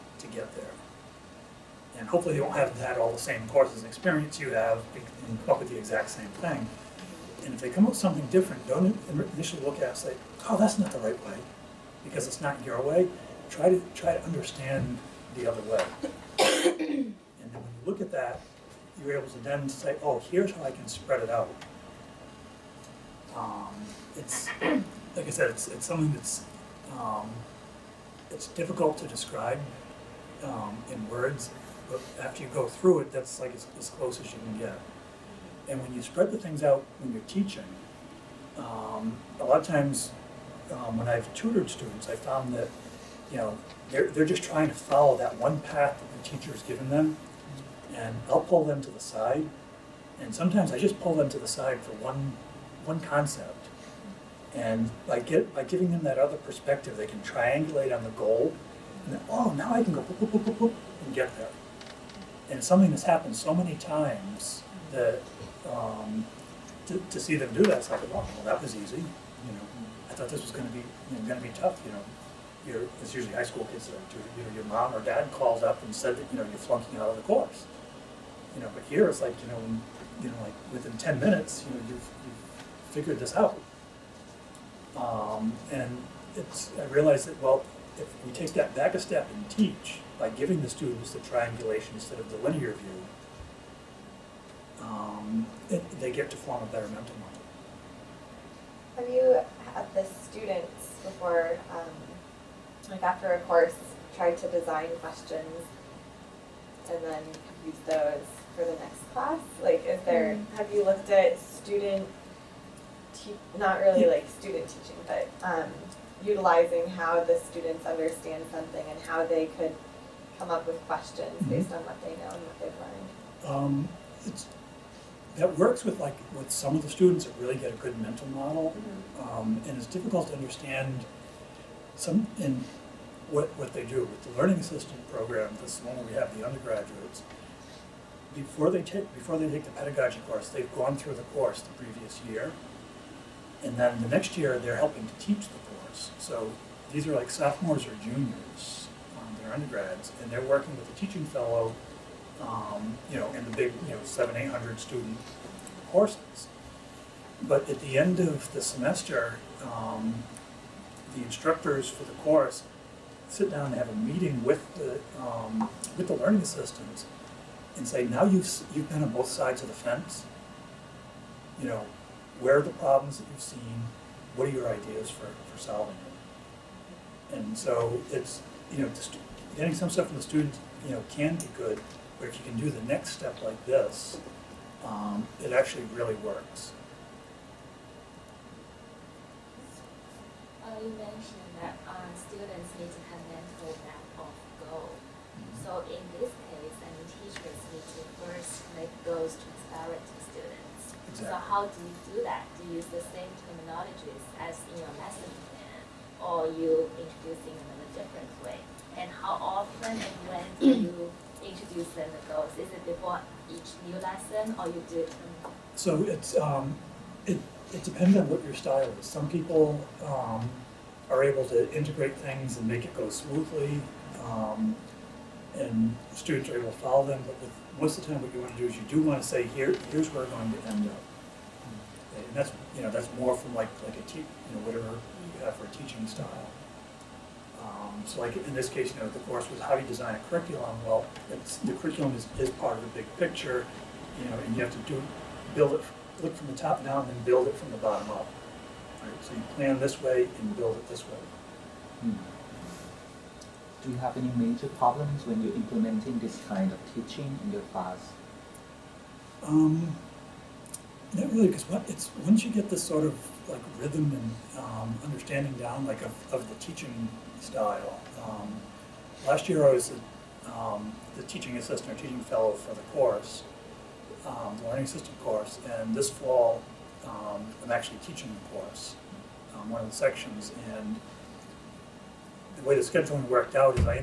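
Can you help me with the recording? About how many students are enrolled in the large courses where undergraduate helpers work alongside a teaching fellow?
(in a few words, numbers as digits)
700 to 800.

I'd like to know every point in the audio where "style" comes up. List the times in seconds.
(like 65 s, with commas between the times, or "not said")
218 s, 236 s, 267 s.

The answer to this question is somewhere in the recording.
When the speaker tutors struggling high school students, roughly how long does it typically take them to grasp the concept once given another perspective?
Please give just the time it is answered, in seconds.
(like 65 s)
80 s.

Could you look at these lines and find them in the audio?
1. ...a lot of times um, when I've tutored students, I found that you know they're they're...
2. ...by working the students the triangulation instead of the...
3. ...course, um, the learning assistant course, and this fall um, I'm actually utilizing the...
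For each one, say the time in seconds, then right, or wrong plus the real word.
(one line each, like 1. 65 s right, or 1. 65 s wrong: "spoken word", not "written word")
1. 39 s right
2. 90 s wrong: "giving", not "working"
3. 272 s wrong: "teaching", not "utilizing".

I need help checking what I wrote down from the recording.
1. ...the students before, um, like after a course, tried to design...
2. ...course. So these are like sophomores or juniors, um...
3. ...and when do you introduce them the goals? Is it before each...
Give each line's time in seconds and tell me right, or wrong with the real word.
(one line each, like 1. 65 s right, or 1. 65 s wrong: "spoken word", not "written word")
1. 99 s right
2. 145 s right
3. 209 s right.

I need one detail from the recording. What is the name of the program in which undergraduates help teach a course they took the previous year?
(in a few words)
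learning assistant program.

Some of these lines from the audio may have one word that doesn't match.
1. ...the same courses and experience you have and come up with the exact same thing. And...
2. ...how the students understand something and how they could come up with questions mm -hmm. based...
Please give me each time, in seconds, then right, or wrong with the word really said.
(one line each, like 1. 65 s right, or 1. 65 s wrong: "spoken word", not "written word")
1. 3 s right
2. 116 s right.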